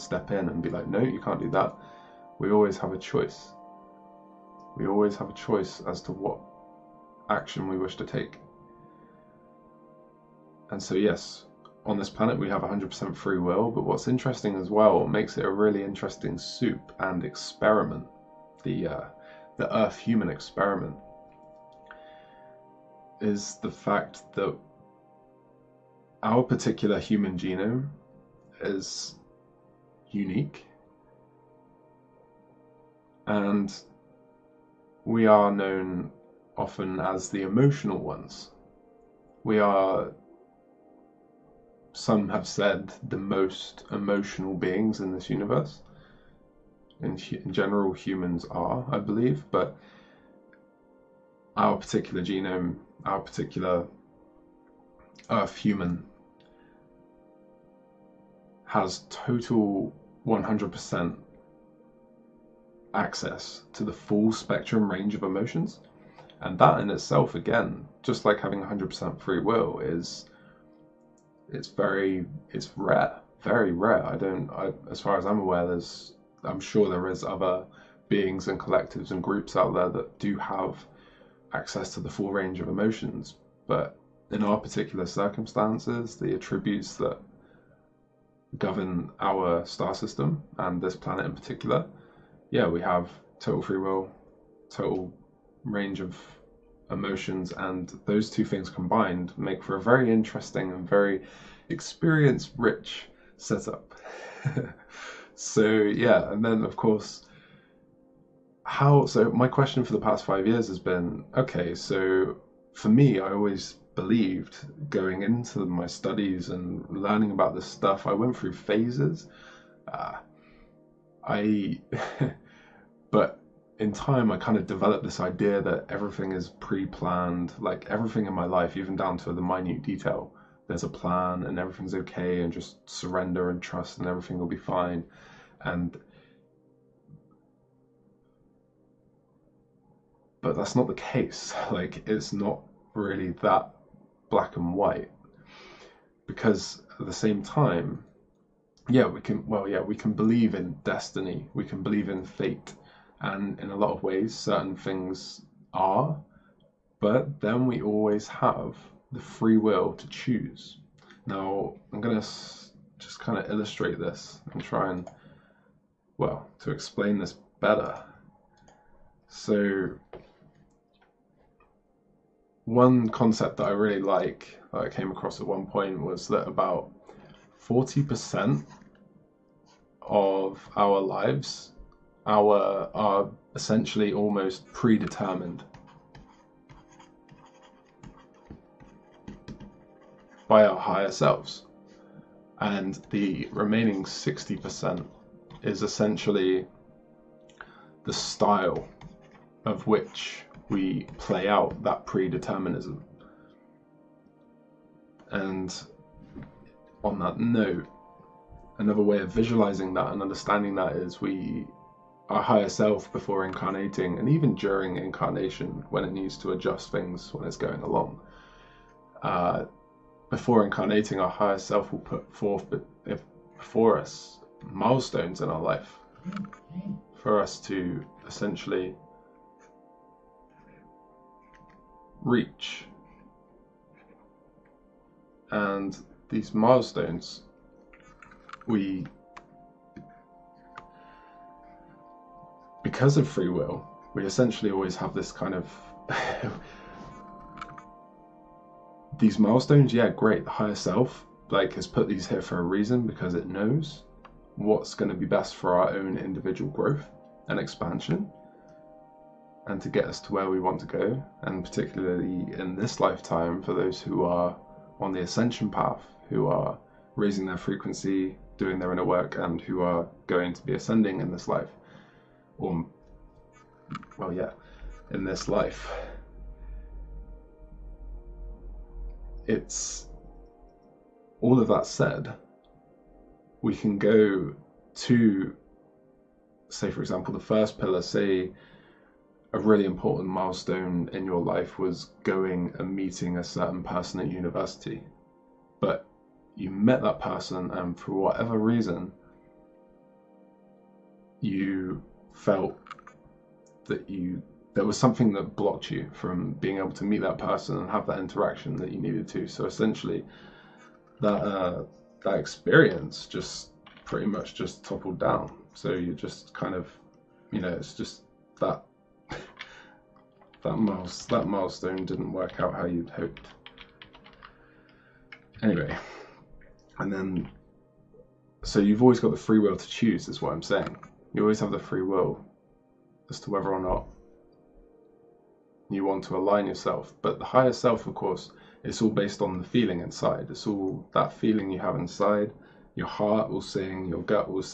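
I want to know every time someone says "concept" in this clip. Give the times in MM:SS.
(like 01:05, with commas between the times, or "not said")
02:53.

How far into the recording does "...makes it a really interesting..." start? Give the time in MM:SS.
00:15.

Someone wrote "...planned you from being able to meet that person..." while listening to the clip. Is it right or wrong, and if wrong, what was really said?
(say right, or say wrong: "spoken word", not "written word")
wrong: "blocked", not "planned".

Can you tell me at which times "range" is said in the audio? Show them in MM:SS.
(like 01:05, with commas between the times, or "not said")
01:04, 01:22, 01:35.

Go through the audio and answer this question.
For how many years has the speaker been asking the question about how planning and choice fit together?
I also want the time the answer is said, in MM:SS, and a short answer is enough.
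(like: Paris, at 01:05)
5 years, at 01:50.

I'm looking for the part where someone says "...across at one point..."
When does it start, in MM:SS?
02:55.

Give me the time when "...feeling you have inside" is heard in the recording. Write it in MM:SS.
05:41.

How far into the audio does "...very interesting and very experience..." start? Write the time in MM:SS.
01:39.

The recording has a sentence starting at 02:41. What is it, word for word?
Now, I'm going to just kind of illustrate this and try and, well, to explain this better.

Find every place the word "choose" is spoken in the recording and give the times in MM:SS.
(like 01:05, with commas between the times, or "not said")
02:40, 05:29.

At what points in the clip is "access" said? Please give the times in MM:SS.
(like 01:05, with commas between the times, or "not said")
01:02, 01:21.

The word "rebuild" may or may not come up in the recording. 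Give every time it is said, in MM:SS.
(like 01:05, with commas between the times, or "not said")
not said.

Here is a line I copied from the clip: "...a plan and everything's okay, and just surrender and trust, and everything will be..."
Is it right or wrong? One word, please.
right.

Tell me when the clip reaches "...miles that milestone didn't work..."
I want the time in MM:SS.
05:20.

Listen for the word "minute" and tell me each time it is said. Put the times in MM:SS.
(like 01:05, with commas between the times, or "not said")
02:09.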